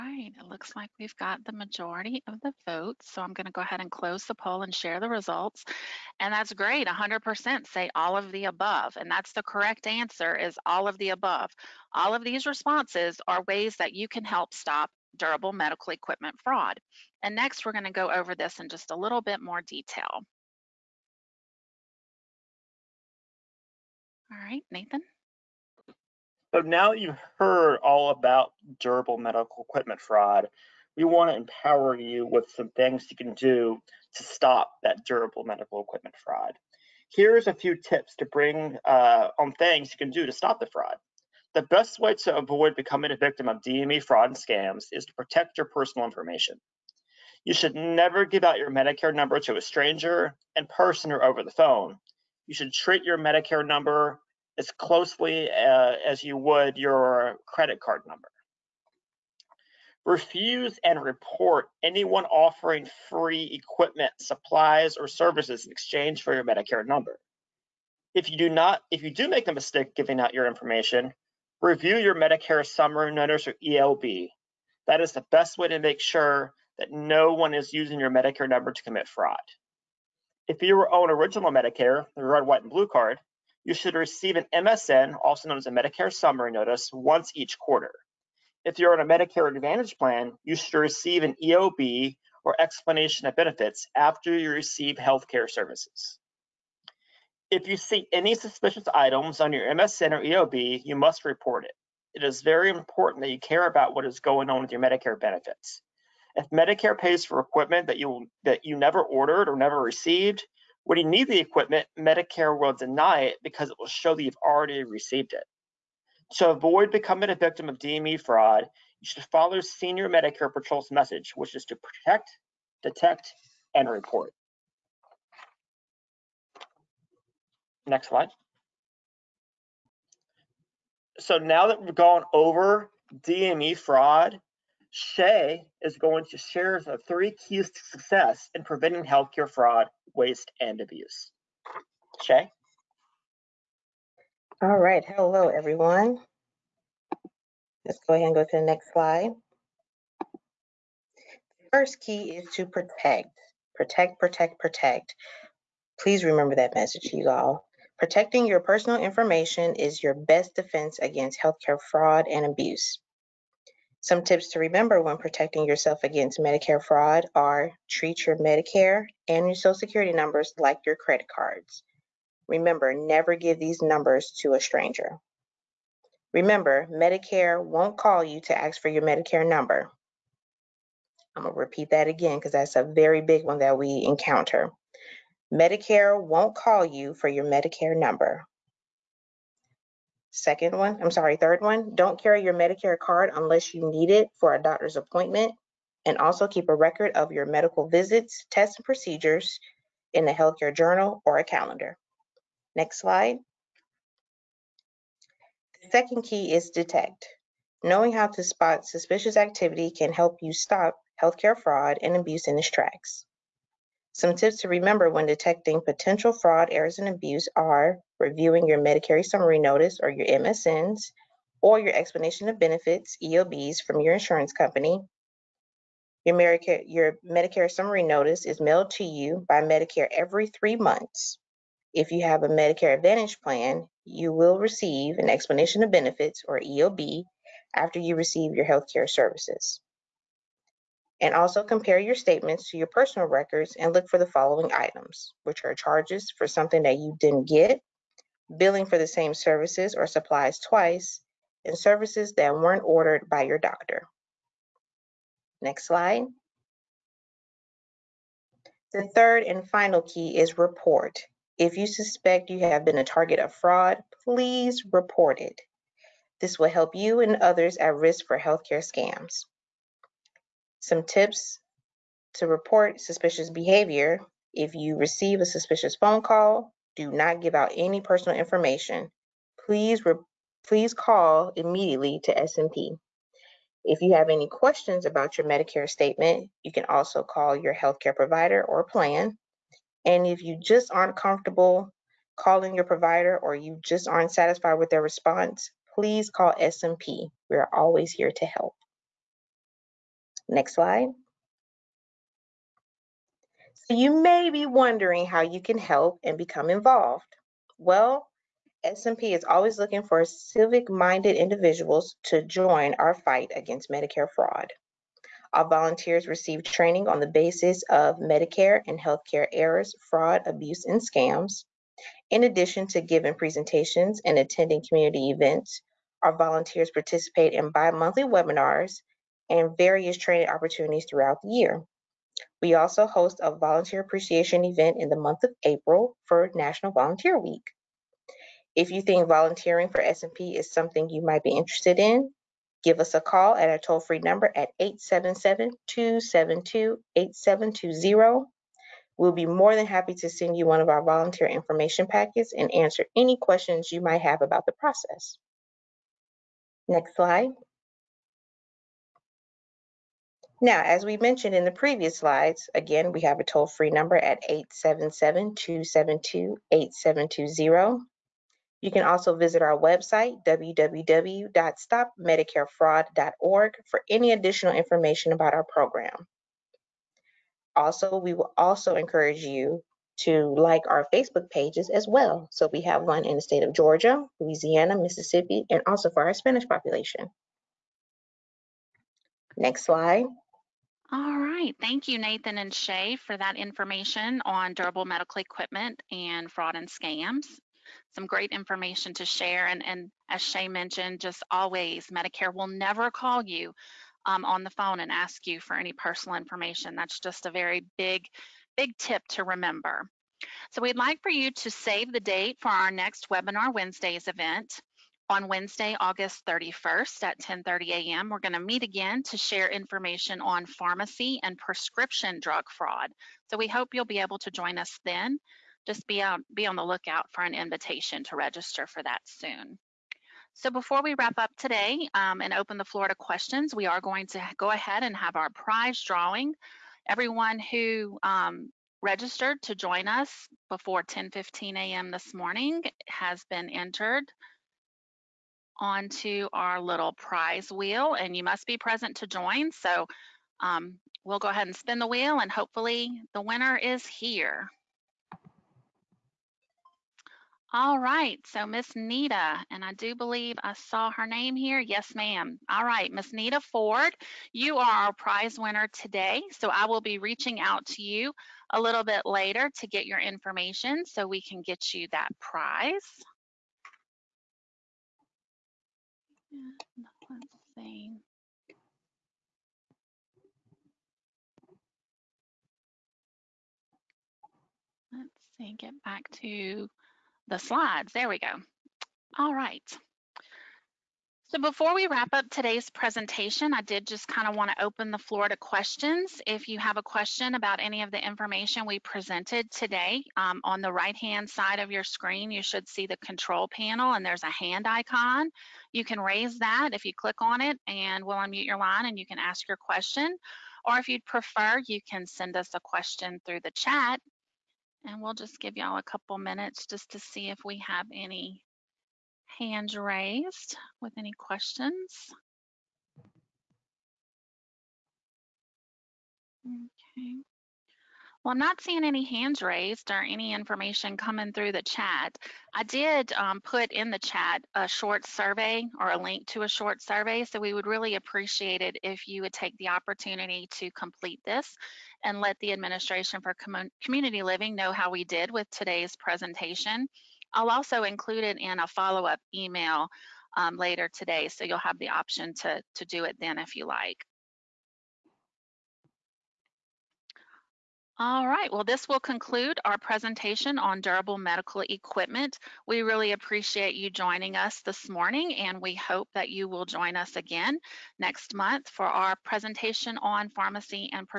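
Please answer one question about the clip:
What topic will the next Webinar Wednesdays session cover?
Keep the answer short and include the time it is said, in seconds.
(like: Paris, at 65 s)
pharmacy and prescription drug fraud, at 420 s.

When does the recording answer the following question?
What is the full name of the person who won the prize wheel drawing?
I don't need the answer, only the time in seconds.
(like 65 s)
463 s.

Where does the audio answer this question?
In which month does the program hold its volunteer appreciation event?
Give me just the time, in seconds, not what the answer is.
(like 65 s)
335 s.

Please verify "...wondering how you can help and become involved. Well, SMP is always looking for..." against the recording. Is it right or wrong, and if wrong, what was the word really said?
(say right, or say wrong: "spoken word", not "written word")
right.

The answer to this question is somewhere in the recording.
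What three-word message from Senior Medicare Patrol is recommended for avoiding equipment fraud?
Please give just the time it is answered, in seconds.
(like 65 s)
121 s.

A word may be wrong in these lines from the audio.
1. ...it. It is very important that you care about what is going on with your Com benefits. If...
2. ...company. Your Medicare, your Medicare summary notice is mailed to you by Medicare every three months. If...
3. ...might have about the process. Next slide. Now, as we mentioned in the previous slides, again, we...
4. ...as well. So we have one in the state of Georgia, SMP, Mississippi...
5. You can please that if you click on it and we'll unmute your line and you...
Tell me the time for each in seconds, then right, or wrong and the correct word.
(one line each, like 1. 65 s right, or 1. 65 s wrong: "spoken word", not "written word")
1. 101 s wrong: "Medicare", not "Com"
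2. 224 s right
3. 354 s right
4. 381 s wrong: "Louisiana", not "SMP"
5. 505 s wrong: "raise", not "please".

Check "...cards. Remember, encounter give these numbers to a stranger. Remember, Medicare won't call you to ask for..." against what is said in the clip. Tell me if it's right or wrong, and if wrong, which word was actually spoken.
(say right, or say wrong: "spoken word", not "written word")
wrong: "never", not "encounter".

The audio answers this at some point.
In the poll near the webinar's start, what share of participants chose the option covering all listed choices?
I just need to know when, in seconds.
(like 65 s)
6 s.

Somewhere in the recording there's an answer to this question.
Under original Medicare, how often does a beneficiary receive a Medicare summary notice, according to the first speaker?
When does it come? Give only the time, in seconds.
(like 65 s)
86 s.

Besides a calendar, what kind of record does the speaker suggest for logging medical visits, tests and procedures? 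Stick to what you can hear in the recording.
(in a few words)
healthcare journal.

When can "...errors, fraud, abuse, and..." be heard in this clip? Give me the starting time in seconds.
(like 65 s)
319 s.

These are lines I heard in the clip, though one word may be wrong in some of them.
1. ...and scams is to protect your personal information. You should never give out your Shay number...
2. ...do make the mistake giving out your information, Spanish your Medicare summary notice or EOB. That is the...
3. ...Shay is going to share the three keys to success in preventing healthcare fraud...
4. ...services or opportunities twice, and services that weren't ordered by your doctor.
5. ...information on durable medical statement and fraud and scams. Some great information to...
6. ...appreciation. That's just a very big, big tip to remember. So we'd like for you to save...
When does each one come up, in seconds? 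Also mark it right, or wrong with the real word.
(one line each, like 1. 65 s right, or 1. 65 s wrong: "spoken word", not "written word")
1. 44 s wrong: "Medicare", not "Shay"
2. 69 s wrong: "Review", not "Spanish"
3. 134 s right
4. 249 s wrong: "supplies", not "opportunities"
5. 393 s wrong: "equipment", not "statement"
6. 406 s wrong: "information", not "appreciation".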